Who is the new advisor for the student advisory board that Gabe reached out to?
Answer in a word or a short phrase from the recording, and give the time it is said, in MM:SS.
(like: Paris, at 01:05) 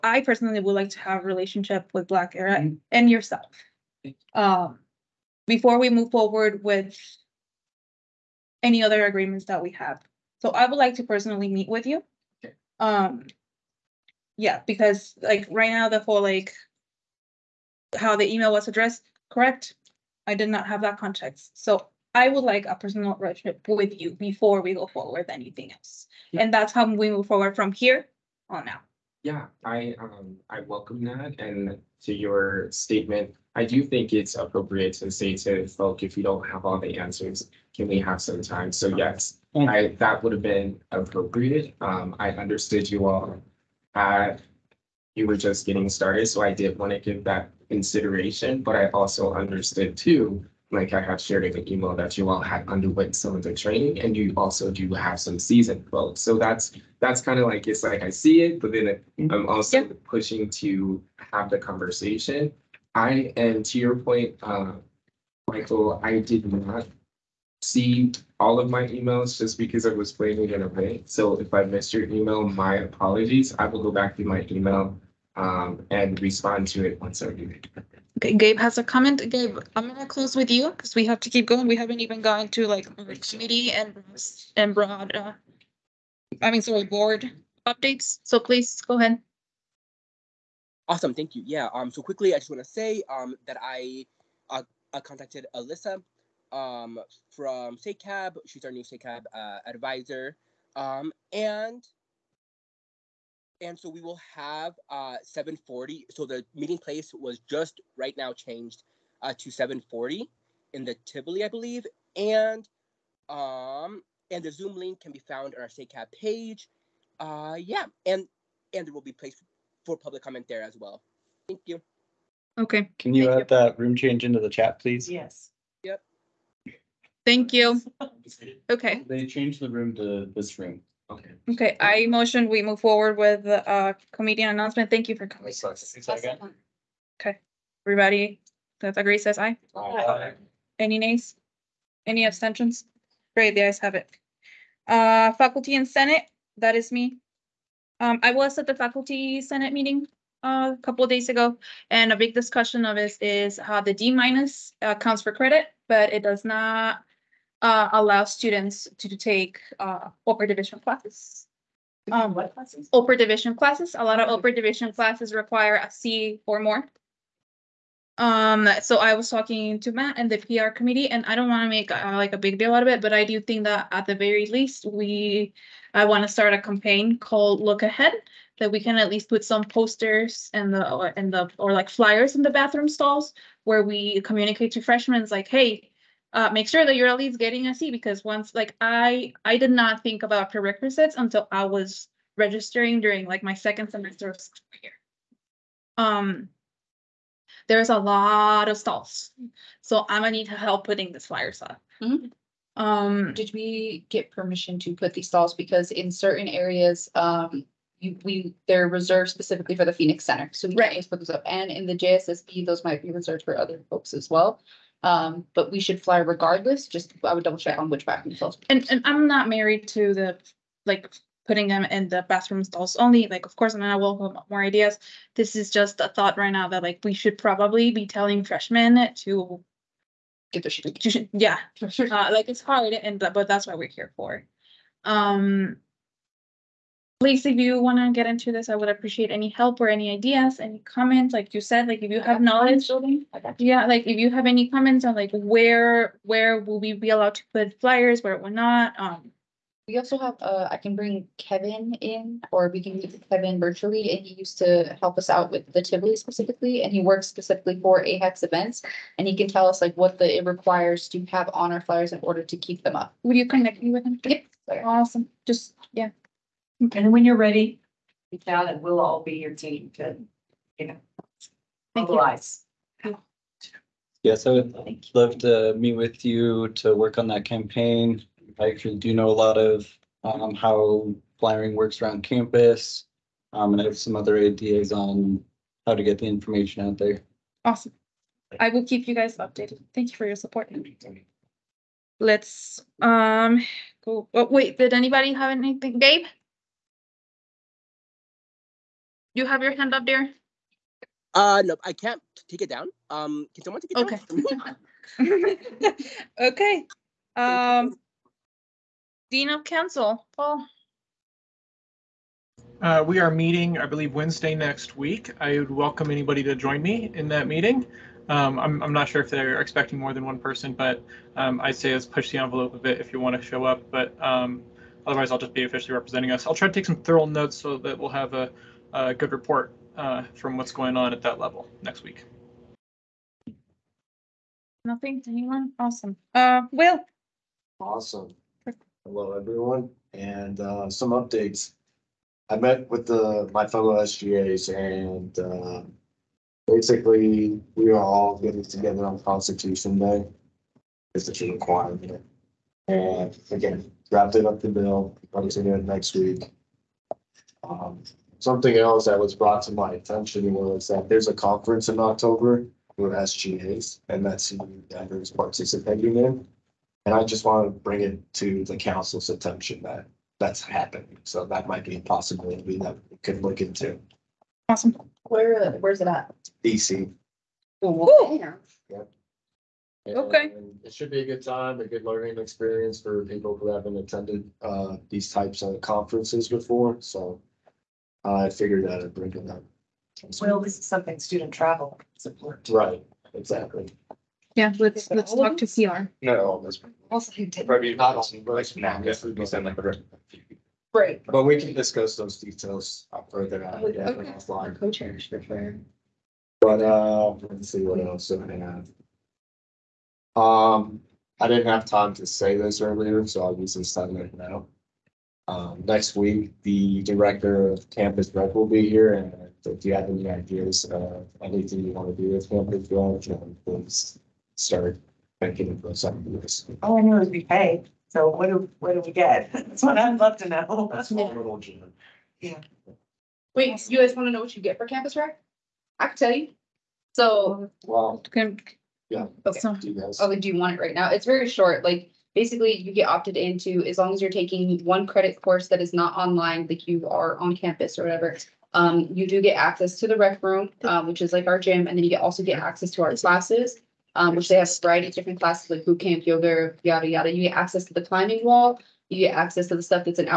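Alyssa, at 01:35.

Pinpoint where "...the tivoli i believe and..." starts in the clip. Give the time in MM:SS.
01:50.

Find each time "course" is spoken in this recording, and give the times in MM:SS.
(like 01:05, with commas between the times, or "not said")
03:43, 07:25.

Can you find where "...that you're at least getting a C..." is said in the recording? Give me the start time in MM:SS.
03:06.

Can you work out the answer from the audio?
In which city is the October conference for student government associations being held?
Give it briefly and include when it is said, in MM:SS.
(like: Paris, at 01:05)
DC, at 06:16.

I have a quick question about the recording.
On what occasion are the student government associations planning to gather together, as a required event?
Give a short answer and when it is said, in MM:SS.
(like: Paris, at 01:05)
Constitution Day, at 05:49.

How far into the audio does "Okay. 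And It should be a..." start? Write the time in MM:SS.
06:20.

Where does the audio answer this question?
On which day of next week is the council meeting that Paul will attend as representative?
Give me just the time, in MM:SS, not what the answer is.
05:14.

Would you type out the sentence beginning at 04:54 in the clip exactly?
Oh, wait, did anybody have anything?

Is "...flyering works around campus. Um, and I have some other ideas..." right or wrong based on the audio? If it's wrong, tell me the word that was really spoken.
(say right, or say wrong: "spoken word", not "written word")
right.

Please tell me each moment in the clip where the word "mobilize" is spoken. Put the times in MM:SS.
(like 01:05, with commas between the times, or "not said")
04:32.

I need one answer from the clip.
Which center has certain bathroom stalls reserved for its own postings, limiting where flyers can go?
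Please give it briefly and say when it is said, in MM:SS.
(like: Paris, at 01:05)
Phoenix Center, at 03:29.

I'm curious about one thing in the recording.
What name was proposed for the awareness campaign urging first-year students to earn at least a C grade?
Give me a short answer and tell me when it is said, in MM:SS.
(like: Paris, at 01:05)
Look Ahead, at 02:57.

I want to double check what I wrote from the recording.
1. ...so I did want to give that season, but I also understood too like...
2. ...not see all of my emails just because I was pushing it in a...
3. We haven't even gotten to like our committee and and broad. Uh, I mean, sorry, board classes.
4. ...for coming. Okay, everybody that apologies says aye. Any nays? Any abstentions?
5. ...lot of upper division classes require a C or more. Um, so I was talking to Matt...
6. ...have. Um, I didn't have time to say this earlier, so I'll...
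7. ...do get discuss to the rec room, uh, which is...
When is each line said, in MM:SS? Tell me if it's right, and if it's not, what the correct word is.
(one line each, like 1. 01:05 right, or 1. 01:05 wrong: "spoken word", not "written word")
1. 00:46 wrong: "consideration", not "season"
2. 01:06 wrong: "playing", not "pushing"
3. 01:21 wrong: "updates", not "classes"
4. 02:15 wrong: "agrees", not "apologies"
5. 02:44 right
6. 06:48 right
7. 07:29 wrong: "access", not "discuss".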